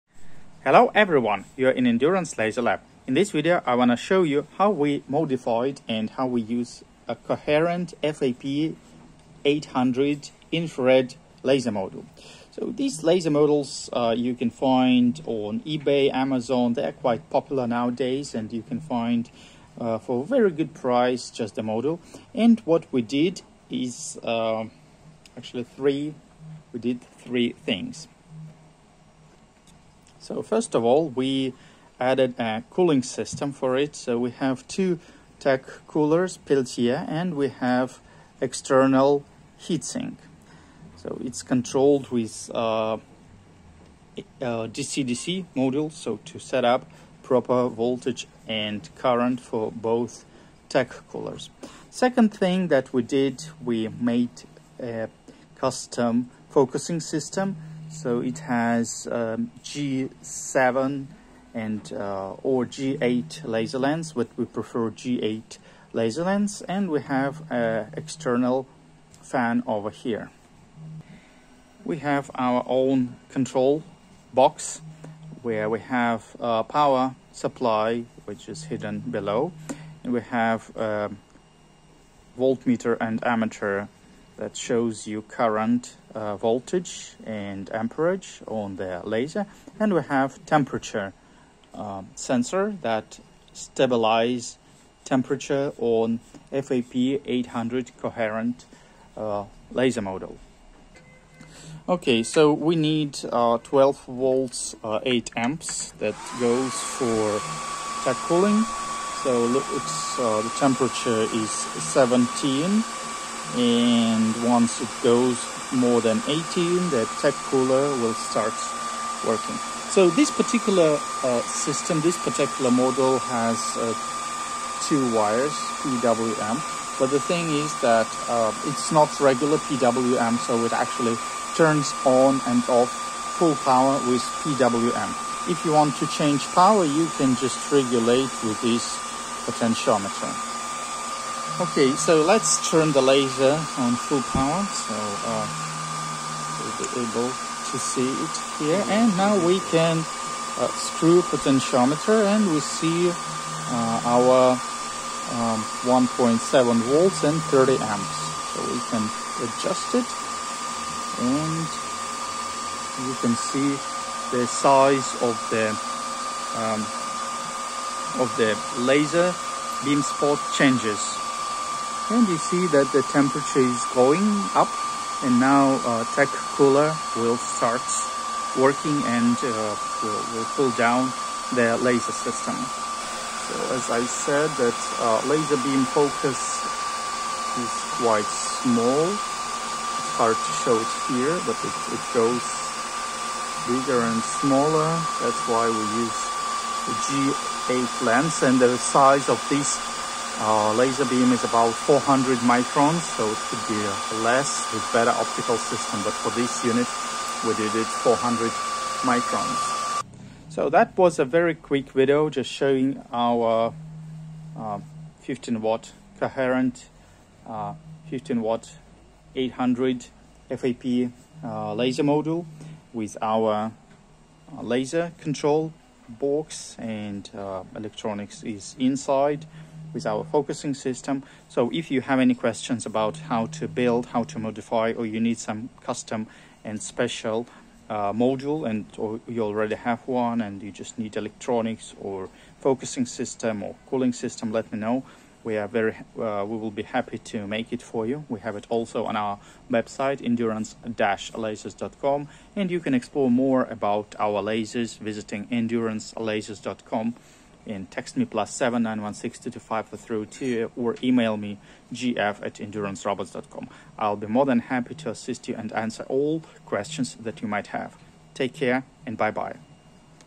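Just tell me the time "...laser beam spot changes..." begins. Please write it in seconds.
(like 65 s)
168 s.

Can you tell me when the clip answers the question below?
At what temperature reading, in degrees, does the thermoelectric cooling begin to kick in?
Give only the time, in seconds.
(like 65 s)
115 s.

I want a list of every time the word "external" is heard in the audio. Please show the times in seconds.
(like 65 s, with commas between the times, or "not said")
38 s, 67 s.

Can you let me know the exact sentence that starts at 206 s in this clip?
But for this unit, we did it 400 microns.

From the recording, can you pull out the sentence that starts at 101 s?
Okay, so we need uh, 12 volts uh, 8 amps that goes for TEC cooling.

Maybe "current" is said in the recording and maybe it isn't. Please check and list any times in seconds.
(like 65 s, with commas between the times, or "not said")
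48 s, 85 s.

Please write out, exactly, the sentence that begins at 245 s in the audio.
We are very, uh, we will be happy to make it for you.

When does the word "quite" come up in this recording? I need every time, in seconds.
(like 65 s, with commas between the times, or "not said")
16 s, 188 s.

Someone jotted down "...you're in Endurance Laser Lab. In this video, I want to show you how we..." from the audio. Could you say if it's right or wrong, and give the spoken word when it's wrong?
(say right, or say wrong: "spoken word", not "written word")
right.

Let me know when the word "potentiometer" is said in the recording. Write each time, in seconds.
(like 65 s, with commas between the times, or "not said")
139 s, 151 s.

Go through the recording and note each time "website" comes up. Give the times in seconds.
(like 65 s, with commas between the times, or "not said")
249 s.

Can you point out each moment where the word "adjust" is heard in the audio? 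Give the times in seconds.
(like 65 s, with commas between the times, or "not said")
159 s.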